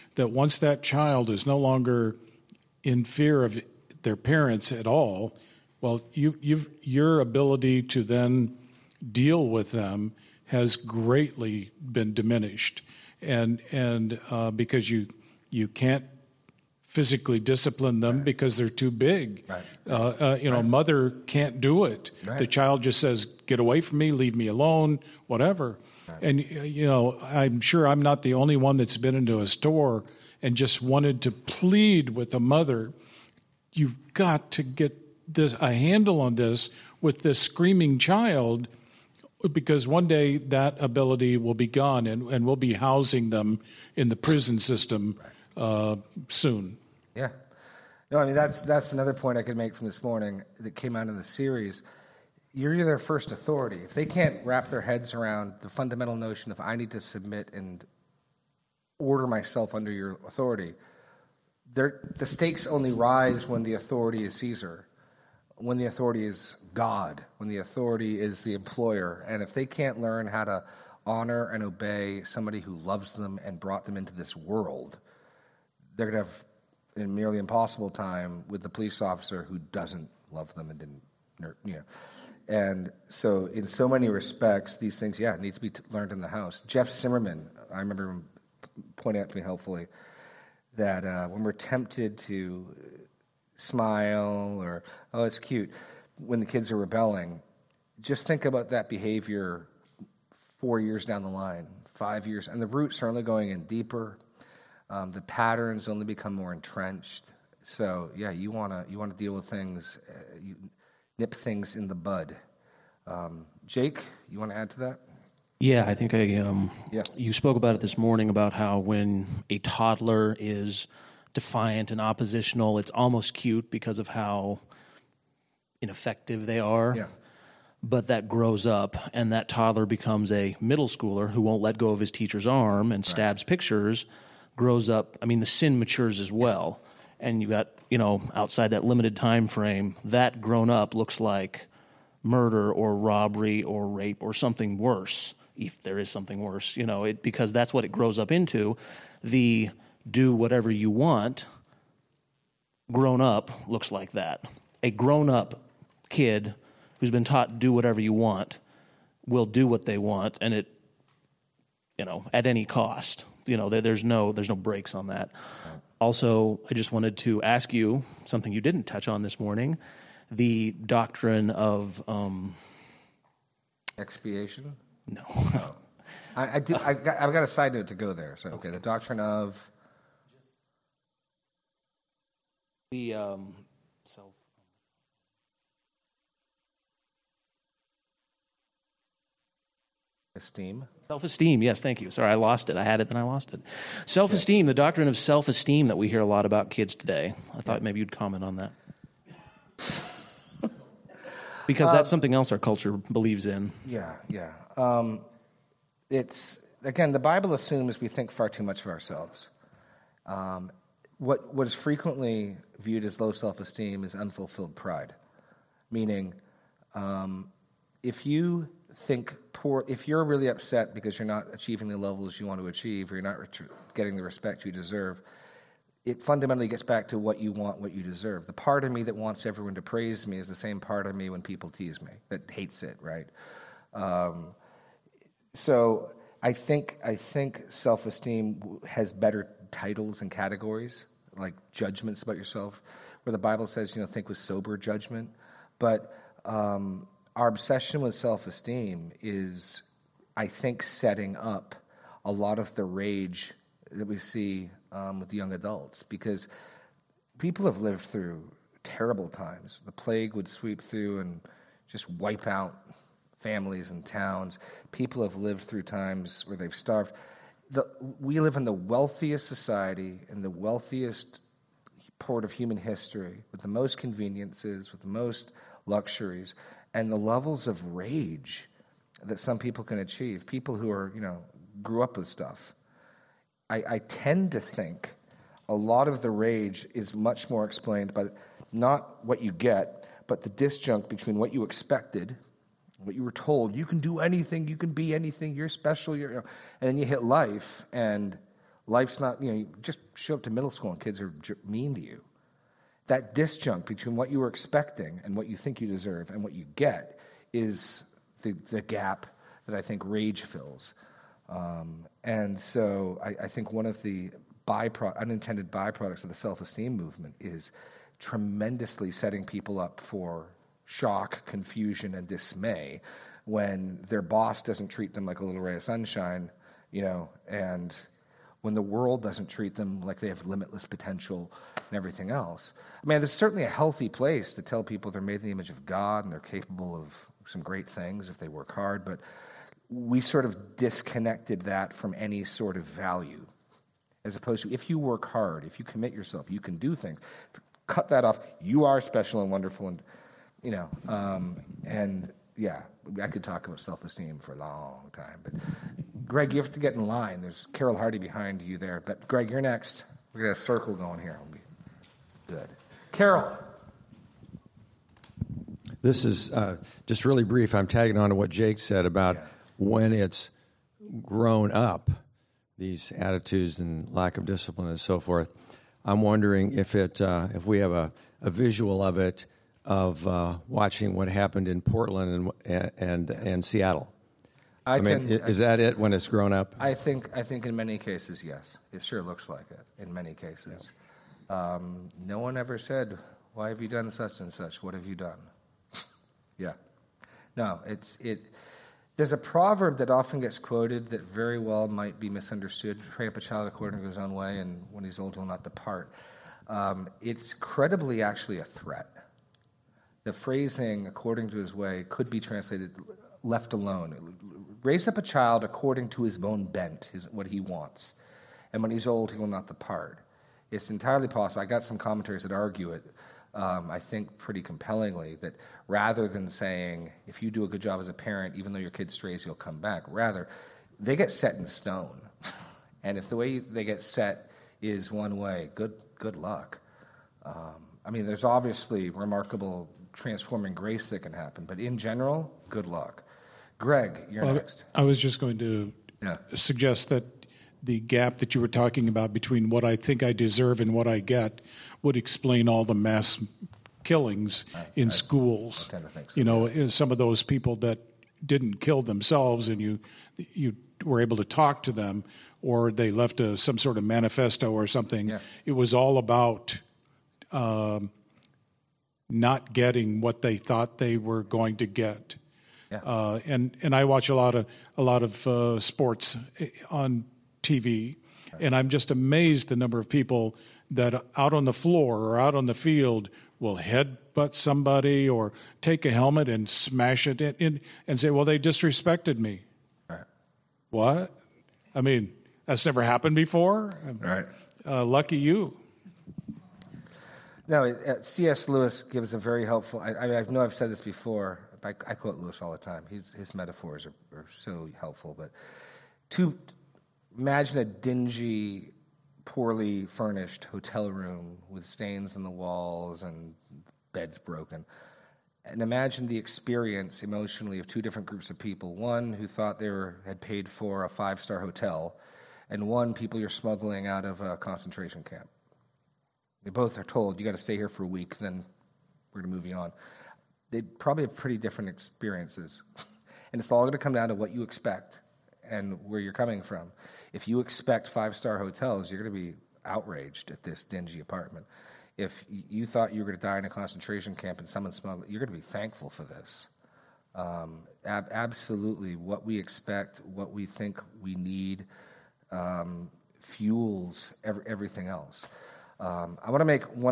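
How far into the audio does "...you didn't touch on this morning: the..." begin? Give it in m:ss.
2:48.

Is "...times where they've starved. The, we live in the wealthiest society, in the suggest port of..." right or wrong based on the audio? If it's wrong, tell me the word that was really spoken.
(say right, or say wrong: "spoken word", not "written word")
wrong: "wealthiest", not "suggest".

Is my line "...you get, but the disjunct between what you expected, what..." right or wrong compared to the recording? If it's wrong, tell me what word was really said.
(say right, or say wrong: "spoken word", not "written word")
right.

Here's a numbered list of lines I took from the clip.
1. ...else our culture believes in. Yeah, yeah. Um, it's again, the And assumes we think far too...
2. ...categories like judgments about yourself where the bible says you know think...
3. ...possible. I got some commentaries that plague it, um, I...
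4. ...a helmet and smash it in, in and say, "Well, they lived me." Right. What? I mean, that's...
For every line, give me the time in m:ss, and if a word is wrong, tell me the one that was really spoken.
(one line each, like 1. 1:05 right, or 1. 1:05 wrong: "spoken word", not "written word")
1. 3:22 wrong: "Bible", not "And"
2. 4:00 right
3. 7:01 wrong: "argue", not "plague"
4. 8:06 wrong: "disrespected", not "lived".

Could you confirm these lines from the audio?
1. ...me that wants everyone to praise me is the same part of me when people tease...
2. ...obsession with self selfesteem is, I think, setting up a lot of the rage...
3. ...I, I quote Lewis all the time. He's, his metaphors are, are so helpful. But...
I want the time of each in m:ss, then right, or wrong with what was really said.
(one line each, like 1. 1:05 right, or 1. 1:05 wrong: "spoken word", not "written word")
1. 3:48 right
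2. 4:07 wrong: "esteem", not "selfesteem"
3. 8:21 right.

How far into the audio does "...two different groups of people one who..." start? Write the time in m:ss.
8:37.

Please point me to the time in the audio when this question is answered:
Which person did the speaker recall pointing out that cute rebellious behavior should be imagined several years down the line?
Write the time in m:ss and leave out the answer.
1:26.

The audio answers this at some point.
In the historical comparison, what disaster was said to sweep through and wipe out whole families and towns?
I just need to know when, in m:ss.
4:19.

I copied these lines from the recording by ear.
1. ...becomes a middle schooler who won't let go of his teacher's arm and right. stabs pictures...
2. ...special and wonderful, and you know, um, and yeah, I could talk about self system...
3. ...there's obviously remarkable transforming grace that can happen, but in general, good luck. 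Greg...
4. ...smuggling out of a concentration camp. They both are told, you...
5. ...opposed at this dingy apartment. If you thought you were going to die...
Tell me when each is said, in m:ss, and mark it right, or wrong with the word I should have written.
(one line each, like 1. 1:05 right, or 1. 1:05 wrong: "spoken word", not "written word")
1. 2:09 right
2. 5:49 wrong: "esteem", not "system"
3. 7:18 right
4. 8:43 right
5. 8:59 wrong: "outraged", not "opposed".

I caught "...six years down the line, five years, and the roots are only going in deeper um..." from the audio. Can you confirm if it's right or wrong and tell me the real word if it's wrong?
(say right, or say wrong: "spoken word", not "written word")
wrong: "four", not "six".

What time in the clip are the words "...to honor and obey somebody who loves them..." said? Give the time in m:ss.
1:10.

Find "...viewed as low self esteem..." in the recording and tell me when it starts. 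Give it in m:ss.
3:32.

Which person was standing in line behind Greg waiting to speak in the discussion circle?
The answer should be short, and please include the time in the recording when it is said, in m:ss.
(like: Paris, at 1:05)
Carol Hardy, at 5:57.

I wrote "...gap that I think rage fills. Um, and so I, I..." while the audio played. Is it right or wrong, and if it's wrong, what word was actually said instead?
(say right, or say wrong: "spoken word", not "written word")
right.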